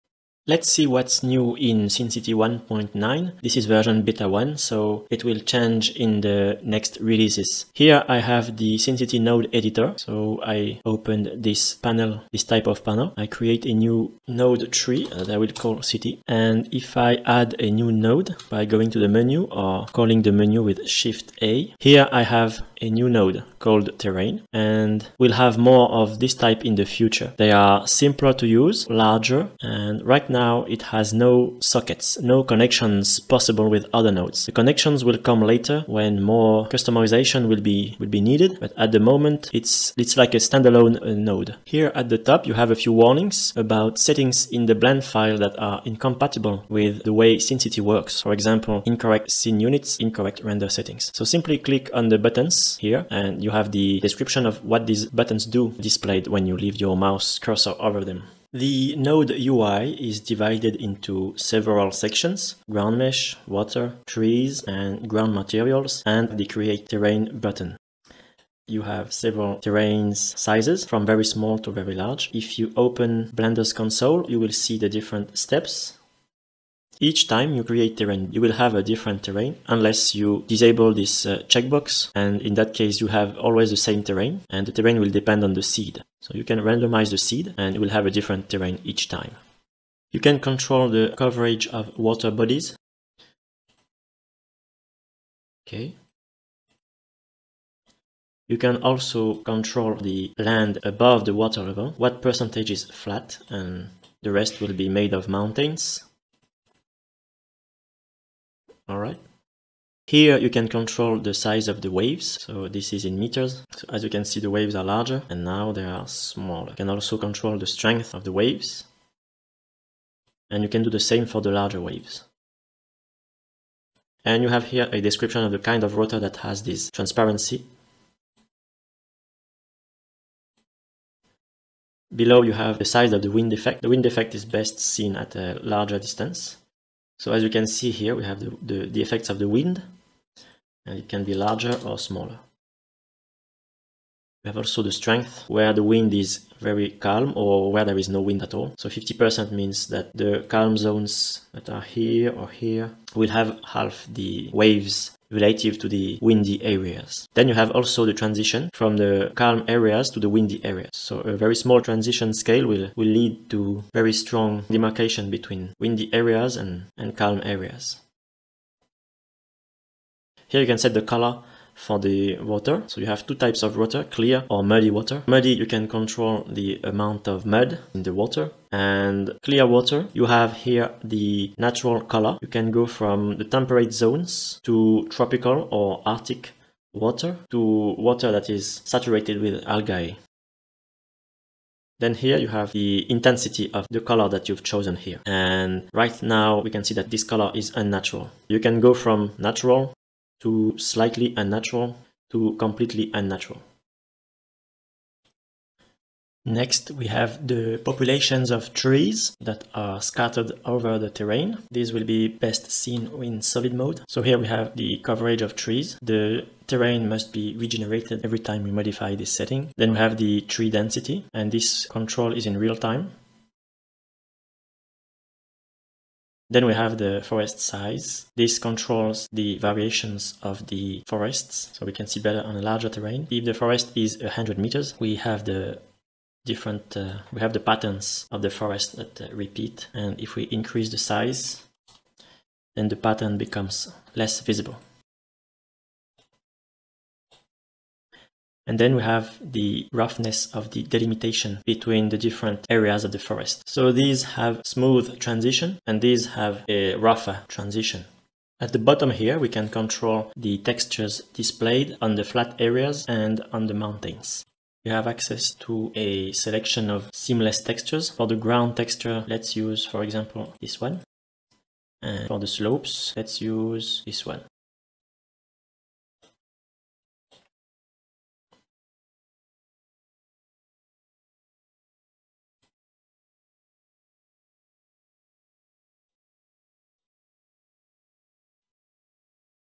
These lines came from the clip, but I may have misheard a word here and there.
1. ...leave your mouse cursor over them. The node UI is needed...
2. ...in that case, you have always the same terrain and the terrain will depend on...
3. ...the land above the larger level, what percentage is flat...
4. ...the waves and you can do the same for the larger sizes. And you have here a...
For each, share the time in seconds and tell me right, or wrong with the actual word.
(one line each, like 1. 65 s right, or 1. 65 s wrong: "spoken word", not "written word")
1. 56 s wrong: "divided", not "needed"
2. 82 s right
3. 99 s wrong: "water", not "larger"
4. 118 s wrong: "waves", not "sizes".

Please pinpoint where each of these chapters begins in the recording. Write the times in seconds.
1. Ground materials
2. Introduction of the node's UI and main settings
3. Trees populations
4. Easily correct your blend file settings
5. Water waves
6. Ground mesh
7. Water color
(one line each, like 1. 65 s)
1. 258 s
2. 58 s
3. 205 s
4. 41 s
5. 109 s
6. 90 s
7. 170 s.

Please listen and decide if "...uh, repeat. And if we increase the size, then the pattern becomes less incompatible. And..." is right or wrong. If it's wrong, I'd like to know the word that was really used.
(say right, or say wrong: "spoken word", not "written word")
wrong: "visible", not "incompatible".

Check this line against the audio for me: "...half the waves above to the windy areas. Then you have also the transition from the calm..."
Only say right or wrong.
wrong.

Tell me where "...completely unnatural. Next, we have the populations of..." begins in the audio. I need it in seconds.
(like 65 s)
202 s.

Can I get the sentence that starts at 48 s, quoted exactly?
For example, incorrect scene units, incorrect render settings.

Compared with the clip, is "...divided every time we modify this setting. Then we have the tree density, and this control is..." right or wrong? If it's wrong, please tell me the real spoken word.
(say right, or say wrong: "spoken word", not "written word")
wrong: "regenerated", not "divided".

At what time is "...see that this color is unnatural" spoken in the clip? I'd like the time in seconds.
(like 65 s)
196 s.